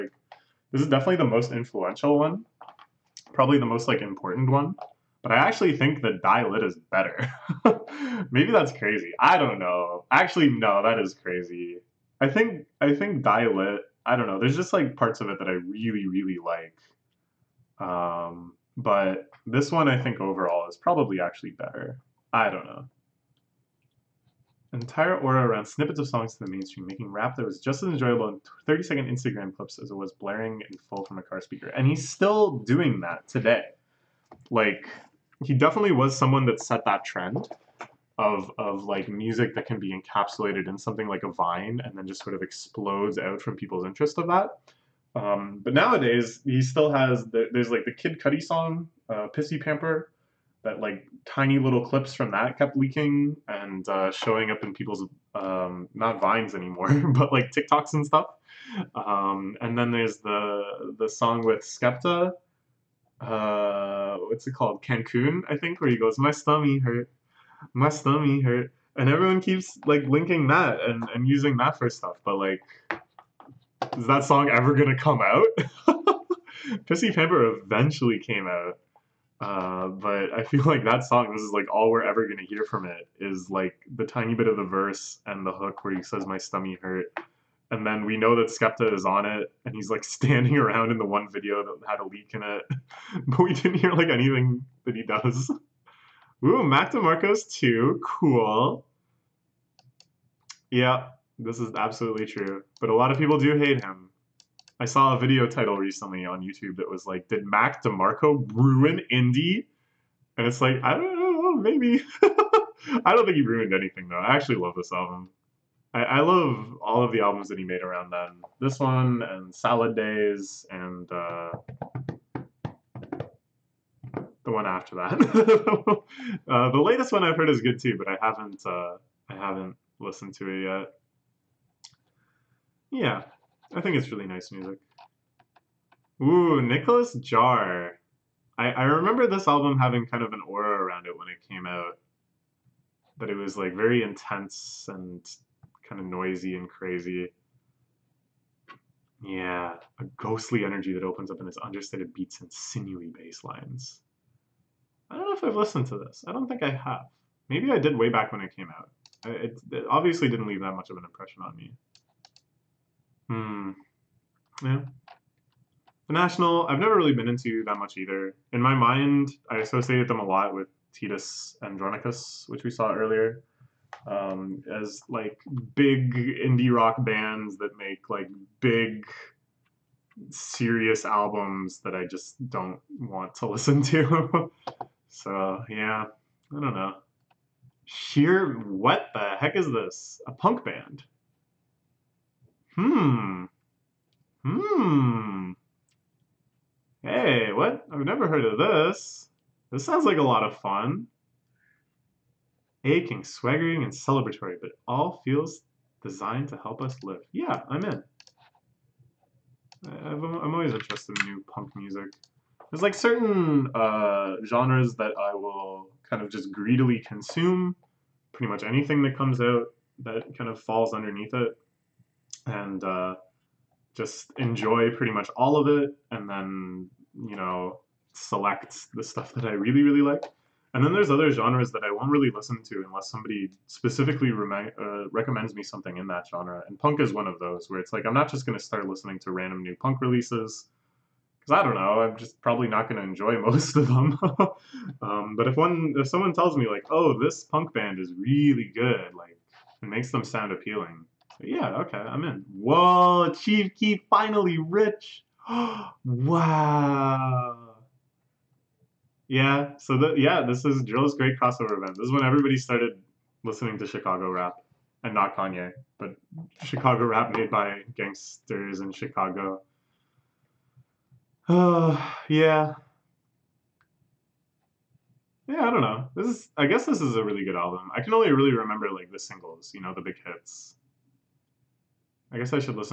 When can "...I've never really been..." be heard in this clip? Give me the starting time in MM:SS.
02:46.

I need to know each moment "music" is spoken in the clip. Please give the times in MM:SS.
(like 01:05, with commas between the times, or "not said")
00:39, 02:14, 03:31.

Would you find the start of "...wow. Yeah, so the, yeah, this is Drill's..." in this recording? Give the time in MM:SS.
04:16.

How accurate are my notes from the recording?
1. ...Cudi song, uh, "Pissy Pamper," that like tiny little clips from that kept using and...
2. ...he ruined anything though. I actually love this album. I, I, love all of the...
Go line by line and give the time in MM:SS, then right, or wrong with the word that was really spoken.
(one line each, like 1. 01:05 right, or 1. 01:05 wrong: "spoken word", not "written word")
1. 00:48 wrong: "leaking", not "using"
2. 01:53 right.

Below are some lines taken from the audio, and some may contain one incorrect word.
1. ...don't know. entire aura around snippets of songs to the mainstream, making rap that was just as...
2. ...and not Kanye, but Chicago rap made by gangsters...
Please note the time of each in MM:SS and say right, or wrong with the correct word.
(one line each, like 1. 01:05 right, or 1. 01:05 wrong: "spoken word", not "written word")
1. 00:22 right
2. 04:25 right.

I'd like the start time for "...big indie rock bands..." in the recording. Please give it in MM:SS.
02:55.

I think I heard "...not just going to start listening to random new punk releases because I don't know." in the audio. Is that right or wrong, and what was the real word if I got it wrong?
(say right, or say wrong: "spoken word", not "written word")
right.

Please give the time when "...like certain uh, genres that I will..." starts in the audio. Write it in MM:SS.
03:32.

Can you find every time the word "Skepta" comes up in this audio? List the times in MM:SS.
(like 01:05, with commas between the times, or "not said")
01:01, 01:28.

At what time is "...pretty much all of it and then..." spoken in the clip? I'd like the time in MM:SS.
03:44.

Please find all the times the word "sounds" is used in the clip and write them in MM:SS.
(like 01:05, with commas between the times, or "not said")
03:19, 04:10.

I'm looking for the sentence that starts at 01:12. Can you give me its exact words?
But like, is that song ever gonna come out?